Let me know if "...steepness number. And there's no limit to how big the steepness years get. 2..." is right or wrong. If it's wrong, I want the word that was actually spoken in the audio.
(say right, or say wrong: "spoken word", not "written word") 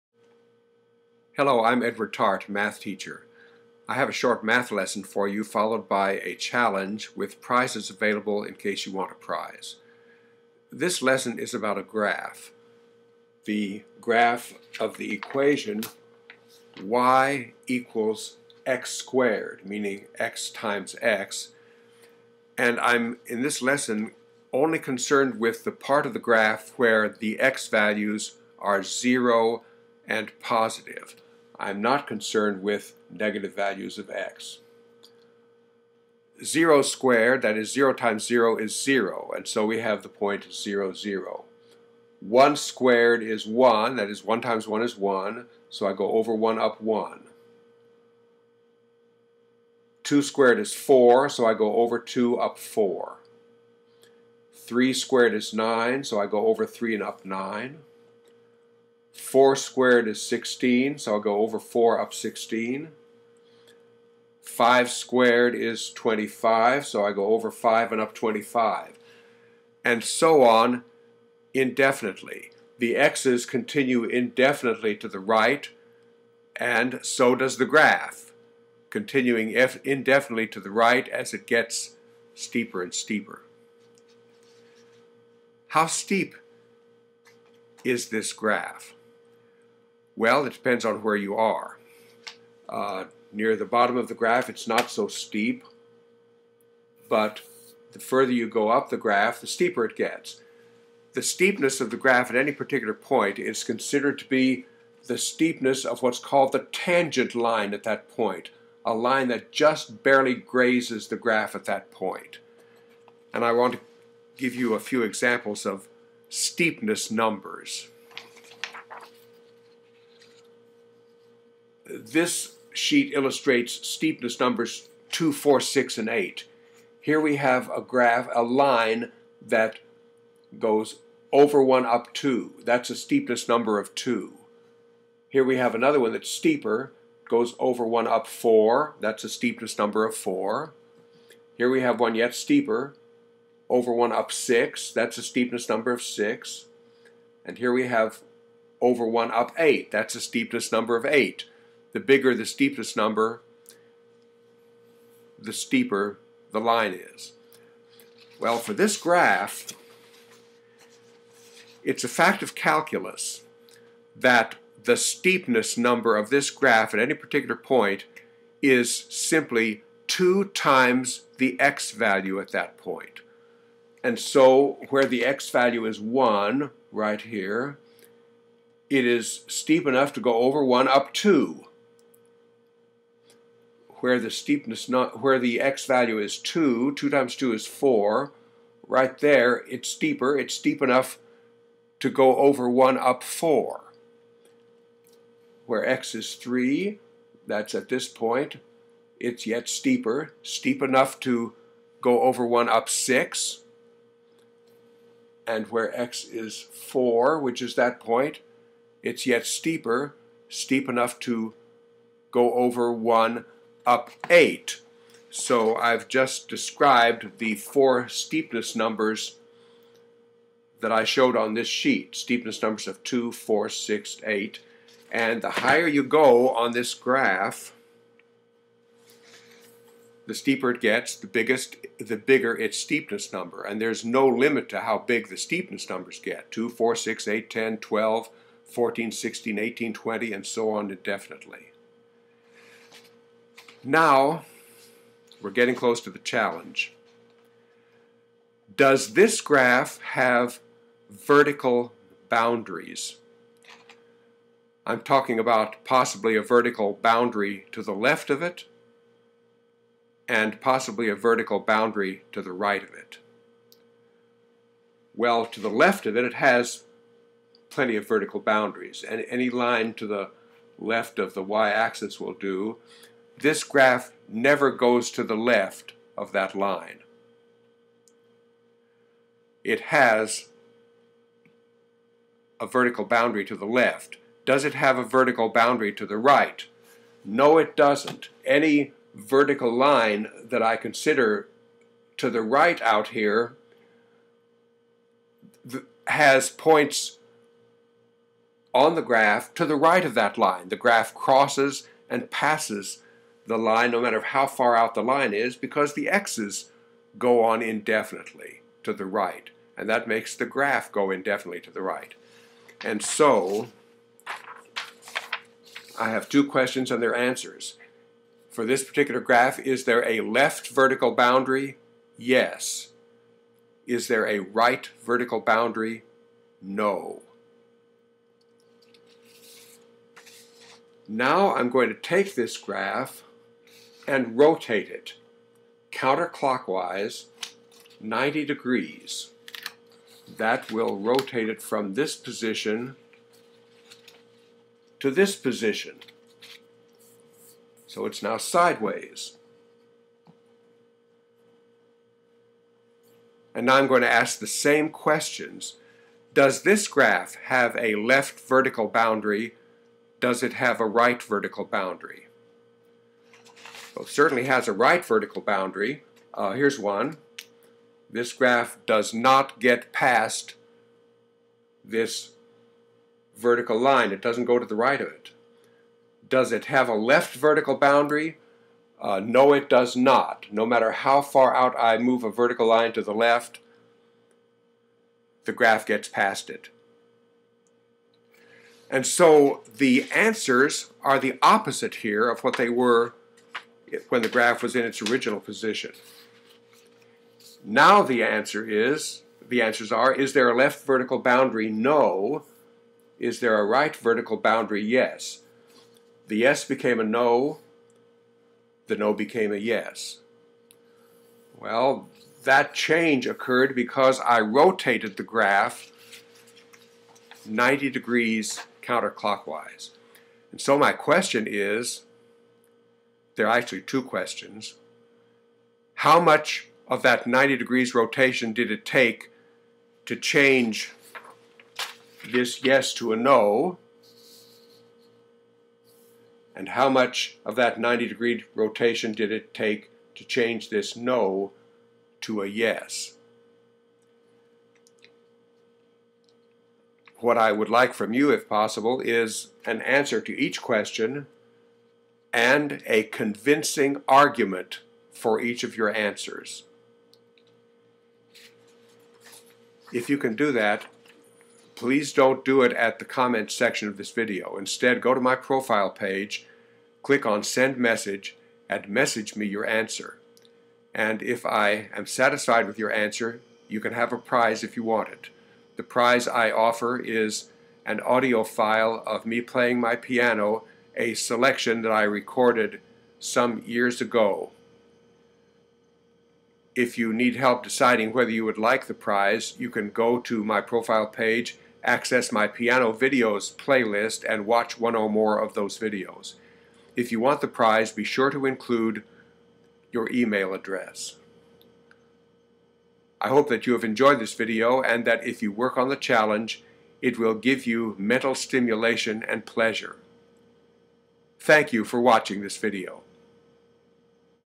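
wrong: "numbers", not "years".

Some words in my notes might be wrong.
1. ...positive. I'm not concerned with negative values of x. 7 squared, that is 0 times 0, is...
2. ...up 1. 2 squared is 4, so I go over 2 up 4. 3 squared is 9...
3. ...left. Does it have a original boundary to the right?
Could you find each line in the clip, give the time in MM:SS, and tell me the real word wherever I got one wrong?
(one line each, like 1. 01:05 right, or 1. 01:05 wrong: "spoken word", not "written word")
1. 00:30 wrong: "0", not "7"
2. 00:46 right
3. 04:43 wrong: "vertical", not "original".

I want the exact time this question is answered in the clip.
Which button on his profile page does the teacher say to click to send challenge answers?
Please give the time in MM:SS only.
07:47.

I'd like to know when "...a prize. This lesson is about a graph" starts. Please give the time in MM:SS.
00:09.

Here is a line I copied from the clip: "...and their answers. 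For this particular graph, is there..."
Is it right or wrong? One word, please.
right.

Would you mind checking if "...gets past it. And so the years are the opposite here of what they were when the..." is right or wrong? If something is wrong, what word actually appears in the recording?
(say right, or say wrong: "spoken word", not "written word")
wrong: "answers", not "years".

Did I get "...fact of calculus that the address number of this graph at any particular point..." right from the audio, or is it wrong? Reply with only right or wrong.
wrong.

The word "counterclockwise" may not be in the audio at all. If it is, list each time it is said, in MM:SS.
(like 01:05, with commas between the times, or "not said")
05:35, 06:58.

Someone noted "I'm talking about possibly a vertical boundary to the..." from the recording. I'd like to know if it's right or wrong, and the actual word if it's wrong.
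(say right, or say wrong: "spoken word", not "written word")
right.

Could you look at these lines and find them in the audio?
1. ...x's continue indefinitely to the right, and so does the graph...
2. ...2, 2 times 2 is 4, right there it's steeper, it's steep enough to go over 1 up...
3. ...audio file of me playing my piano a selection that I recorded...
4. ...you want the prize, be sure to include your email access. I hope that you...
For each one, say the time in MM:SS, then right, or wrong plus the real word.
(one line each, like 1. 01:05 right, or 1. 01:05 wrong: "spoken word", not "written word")
1. 01:12 right
2. 03:06 right
3. 07:58 right
4. 08:17 wrong: "address", not "access".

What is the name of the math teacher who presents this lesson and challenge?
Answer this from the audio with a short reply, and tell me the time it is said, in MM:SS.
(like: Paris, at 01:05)
Edward Tarte, at 00:01.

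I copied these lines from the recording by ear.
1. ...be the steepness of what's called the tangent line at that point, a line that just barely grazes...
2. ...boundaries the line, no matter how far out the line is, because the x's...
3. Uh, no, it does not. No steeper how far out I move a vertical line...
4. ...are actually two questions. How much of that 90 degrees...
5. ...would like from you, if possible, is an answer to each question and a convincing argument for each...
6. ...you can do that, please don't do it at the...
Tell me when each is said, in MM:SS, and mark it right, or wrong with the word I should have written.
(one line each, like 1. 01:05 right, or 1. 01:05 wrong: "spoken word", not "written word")
1. 01:44 right
2. 05:02 wrong: "passes", not "boundaries"
3. 06:19 wrong: "matter", not "steeper"
4. 07:03 right
5. 07:27 right
6. 07:40 right.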